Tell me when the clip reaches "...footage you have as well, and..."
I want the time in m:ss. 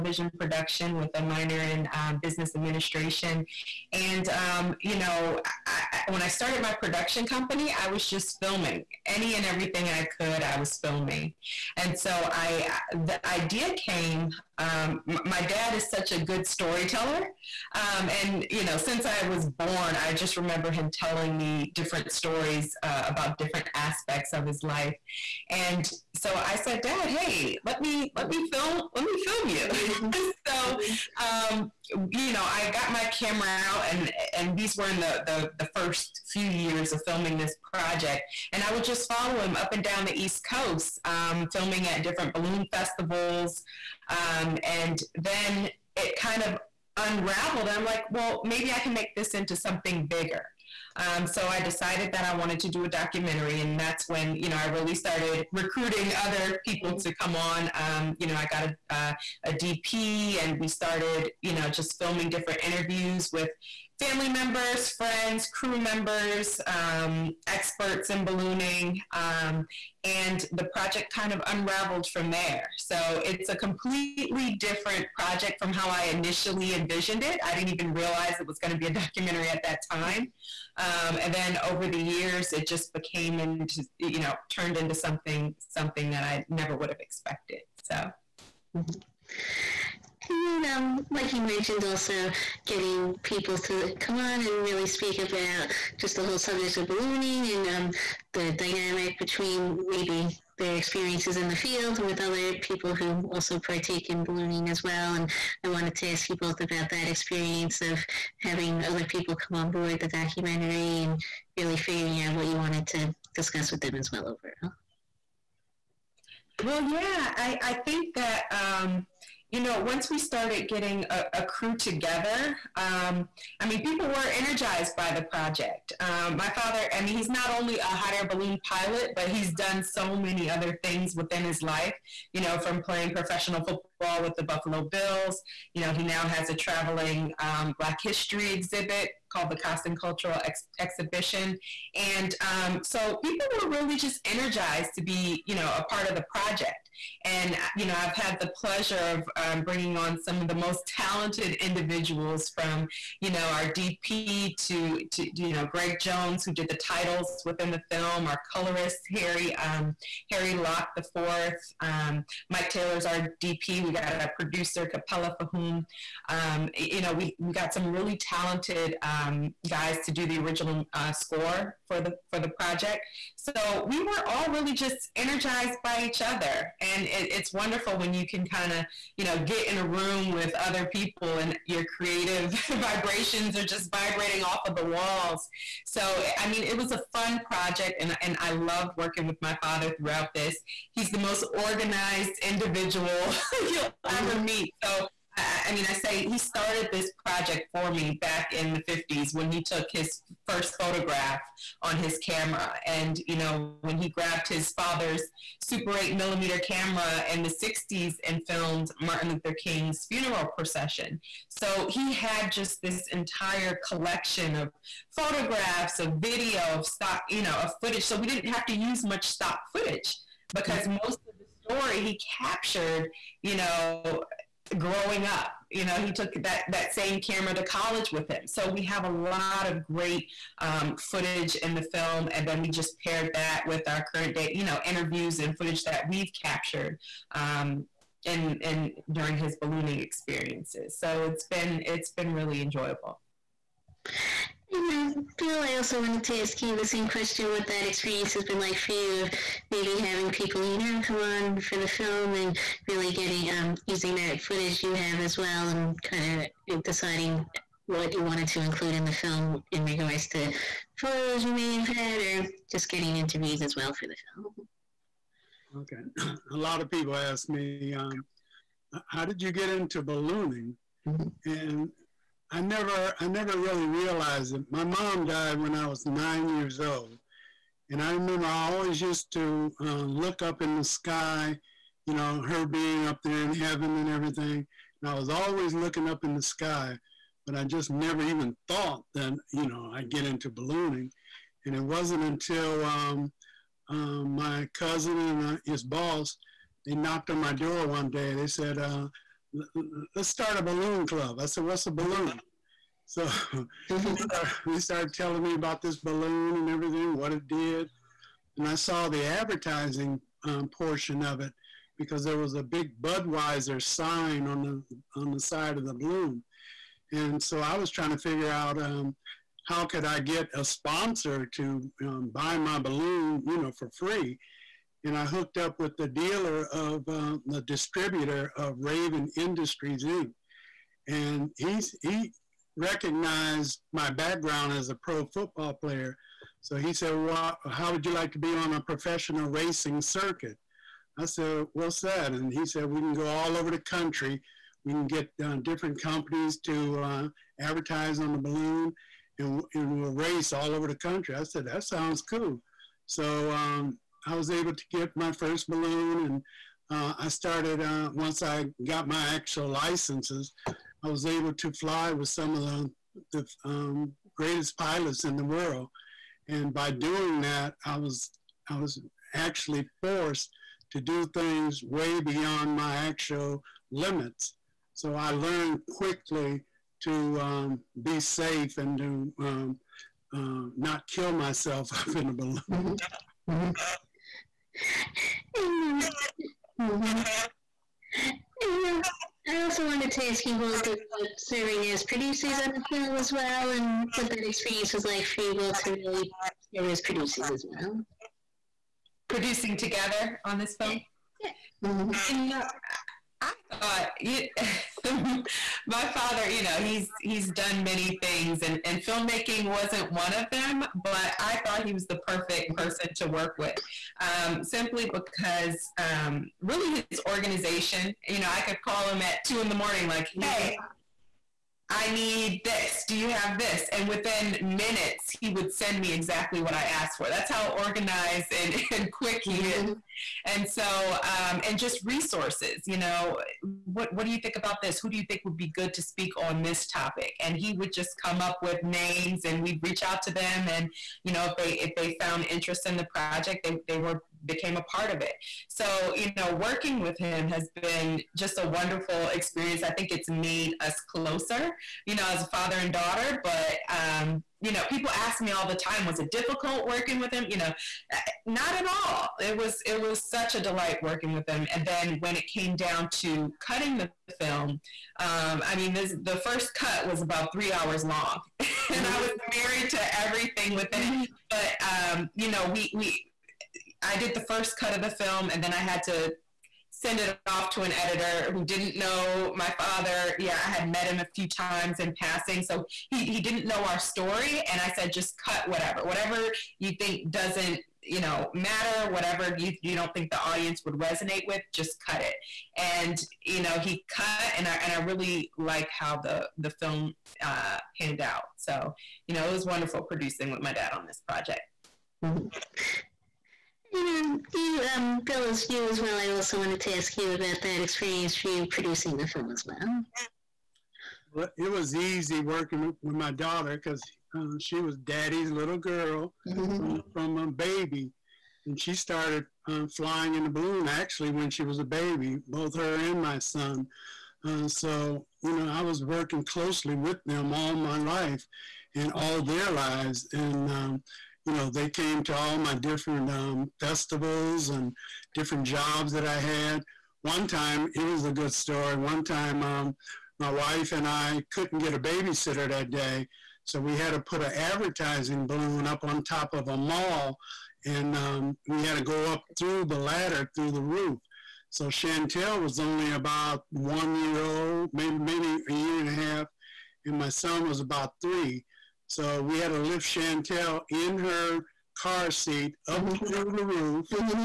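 4:14.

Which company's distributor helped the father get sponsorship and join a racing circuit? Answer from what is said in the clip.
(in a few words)
Raven Industries Inc.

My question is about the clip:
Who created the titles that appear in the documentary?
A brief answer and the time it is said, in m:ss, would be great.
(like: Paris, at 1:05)
Greg Jones, at 2:35.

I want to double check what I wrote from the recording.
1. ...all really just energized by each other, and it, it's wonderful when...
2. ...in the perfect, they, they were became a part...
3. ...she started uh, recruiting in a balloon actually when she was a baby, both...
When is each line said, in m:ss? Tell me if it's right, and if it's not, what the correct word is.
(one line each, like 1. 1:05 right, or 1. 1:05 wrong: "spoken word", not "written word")
1. 2:54 right
2. 7:22 wrong: "project", not "perfect"
3. 8:38 wrong: "flying", not "recruiting".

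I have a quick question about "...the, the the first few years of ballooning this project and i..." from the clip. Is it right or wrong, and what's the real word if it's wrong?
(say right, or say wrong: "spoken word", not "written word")
wrong: "filming", not "ballooning".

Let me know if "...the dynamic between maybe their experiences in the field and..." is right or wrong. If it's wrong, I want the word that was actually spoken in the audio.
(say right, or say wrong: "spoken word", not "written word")
right.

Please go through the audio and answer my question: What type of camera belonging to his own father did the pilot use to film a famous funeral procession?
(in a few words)
Super 8 millimeter.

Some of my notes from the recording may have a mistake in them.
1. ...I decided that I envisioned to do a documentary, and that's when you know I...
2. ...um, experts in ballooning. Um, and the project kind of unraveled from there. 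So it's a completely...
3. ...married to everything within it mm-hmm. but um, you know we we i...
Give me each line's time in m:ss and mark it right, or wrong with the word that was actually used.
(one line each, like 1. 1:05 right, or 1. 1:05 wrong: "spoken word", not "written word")
1. 0:51 wrong: "wanted", not "envisioned"
2. 1:06 right
3. 7:49 right.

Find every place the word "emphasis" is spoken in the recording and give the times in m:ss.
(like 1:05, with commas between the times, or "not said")
not said.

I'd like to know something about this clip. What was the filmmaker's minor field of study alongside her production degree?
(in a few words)
Business administration.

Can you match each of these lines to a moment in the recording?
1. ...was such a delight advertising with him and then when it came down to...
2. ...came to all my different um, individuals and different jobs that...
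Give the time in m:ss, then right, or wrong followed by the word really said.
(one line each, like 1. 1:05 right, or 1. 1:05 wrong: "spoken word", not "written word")
1. 7:39 wrong: "working", not "advertising"
2. 8:51 wrong: "festivals", not "individuals".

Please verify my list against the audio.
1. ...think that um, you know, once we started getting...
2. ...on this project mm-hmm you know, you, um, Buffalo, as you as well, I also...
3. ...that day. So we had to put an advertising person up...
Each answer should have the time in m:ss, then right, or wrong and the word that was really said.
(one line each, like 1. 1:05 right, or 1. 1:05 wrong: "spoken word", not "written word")
1. 1:57 right
2. 8:20 wrong: "Bill", not "Buffalo"
3. 9:02 wrong: "balloon", not "person".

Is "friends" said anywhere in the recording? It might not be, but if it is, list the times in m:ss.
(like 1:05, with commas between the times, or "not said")
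1:04.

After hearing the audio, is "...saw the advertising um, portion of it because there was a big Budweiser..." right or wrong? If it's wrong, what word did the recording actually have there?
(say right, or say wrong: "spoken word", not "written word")
right.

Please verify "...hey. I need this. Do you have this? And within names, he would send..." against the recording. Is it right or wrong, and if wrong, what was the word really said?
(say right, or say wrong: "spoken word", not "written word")
wrong: "minutes", not "names".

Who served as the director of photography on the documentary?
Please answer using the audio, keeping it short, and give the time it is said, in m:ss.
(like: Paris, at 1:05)
Mike Taylor, at 2:42.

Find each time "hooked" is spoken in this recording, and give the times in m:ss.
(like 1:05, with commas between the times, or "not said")
5:25.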